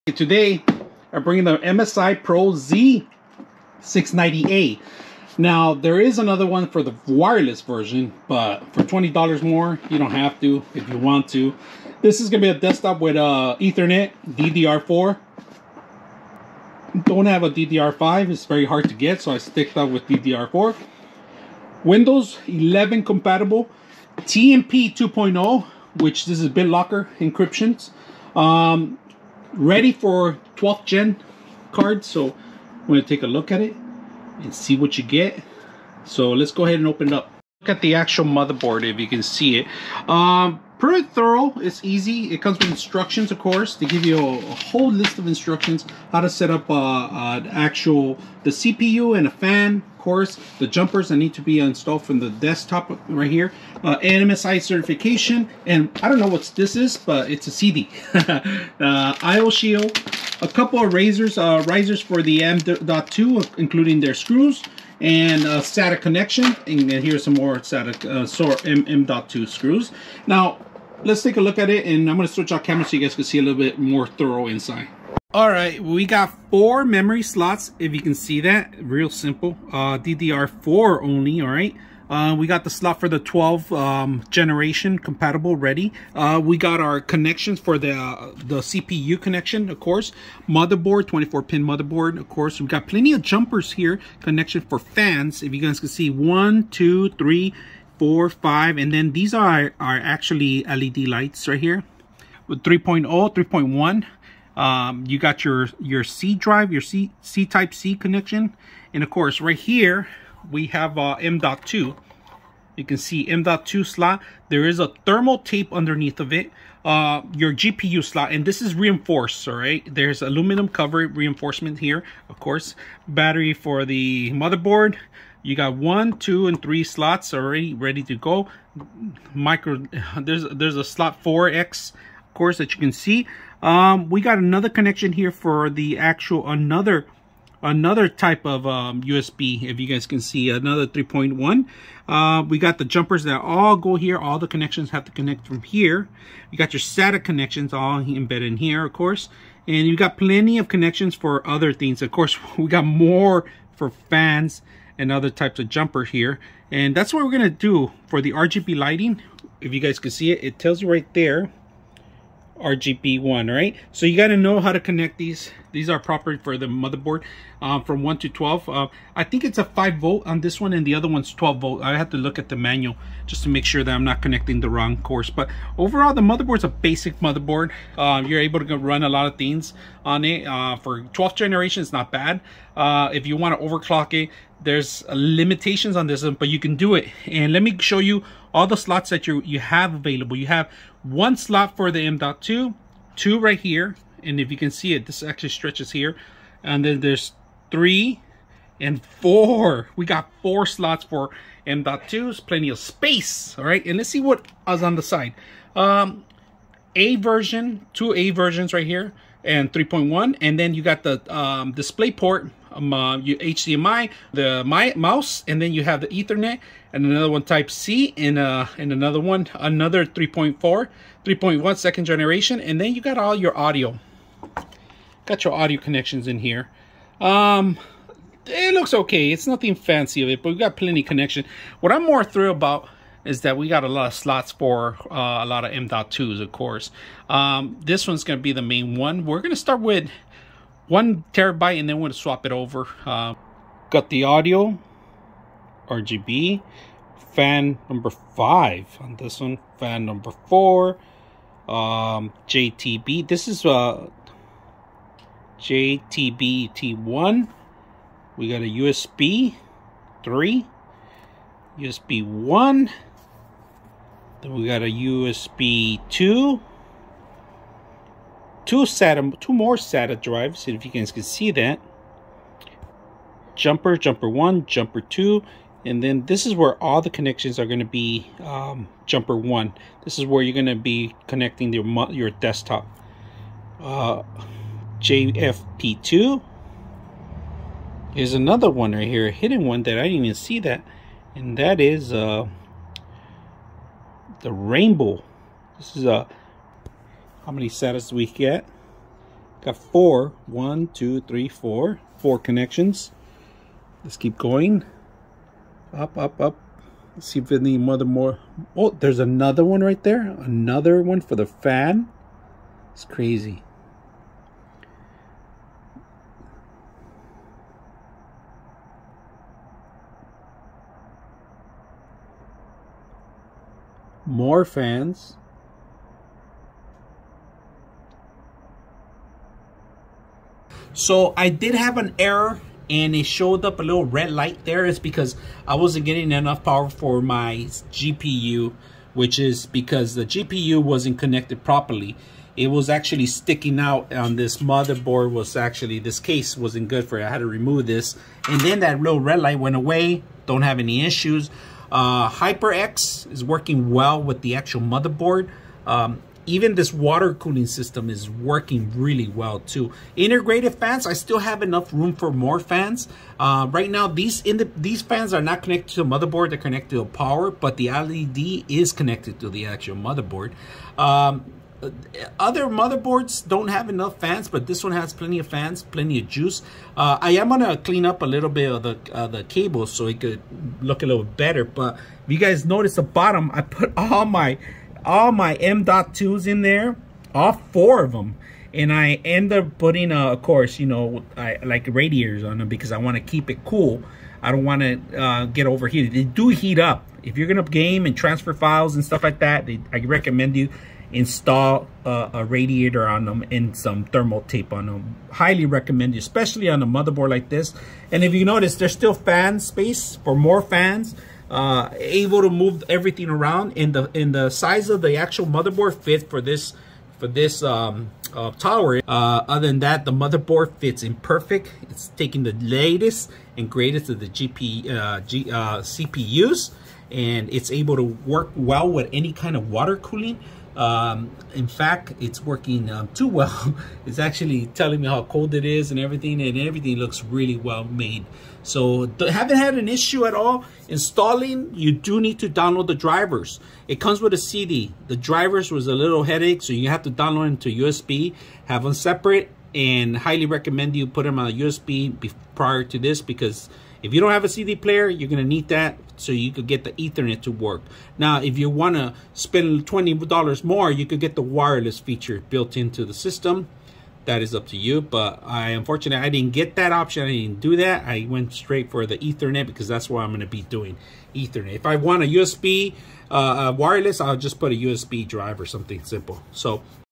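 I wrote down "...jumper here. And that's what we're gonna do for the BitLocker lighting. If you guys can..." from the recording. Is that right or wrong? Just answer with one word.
wrong.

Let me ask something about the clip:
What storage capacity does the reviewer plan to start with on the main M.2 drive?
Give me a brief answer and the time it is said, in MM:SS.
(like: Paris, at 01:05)
1 terabyte, at 04:00.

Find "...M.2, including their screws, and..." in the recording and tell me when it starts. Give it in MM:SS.
01:02.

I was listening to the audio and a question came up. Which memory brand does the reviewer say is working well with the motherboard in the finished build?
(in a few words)
HyperX.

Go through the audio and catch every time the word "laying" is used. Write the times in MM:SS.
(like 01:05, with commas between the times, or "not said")
not said.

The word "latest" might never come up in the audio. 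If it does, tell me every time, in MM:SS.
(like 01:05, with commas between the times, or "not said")
07:02.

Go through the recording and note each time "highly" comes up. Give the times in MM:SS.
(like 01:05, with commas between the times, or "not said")
06:45, 07:30.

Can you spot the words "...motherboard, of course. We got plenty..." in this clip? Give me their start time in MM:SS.
01:31.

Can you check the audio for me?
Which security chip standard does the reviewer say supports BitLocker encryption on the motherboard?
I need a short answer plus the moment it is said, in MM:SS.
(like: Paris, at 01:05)
TMP 2.0, at 00:24.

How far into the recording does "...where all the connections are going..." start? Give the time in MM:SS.
04:36.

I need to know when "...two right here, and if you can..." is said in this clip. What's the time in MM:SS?
03:13.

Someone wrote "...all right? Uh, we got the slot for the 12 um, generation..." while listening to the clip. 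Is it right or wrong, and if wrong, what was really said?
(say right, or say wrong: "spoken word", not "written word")
right.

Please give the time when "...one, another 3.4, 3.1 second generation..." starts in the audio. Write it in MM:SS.
03:39.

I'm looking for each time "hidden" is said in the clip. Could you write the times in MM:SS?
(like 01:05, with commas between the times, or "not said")
04:49.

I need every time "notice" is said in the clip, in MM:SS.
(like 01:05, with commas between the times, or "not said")
06:22, 06:48.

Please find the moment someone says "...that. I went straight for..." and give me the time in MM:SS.
07:47.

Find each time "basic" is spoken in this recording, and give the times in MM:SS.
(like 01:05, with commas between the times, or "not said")
02:56.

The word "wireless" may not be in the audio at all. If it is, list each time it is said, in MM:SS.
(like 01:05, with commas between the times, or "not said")
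00:07, 07:41, 07:53.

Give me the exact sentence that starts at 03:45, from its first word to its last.
Got your audio connections in here.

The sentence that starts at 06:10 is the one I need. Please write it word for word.
Um, uh, other motherboards don't have enough fans, but this one has plenty of fans, plenty of juice.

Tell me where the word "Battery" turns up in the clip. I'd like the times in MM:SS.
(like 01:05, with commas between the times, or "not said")
02:03.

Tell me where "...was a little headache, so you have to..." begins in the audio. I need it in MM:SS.
07:25.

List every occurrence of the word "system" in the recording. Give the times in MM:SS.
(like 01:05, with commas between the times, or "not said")
05:57, 07:43.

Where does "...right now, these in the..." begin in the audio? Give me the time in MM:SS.
06:03.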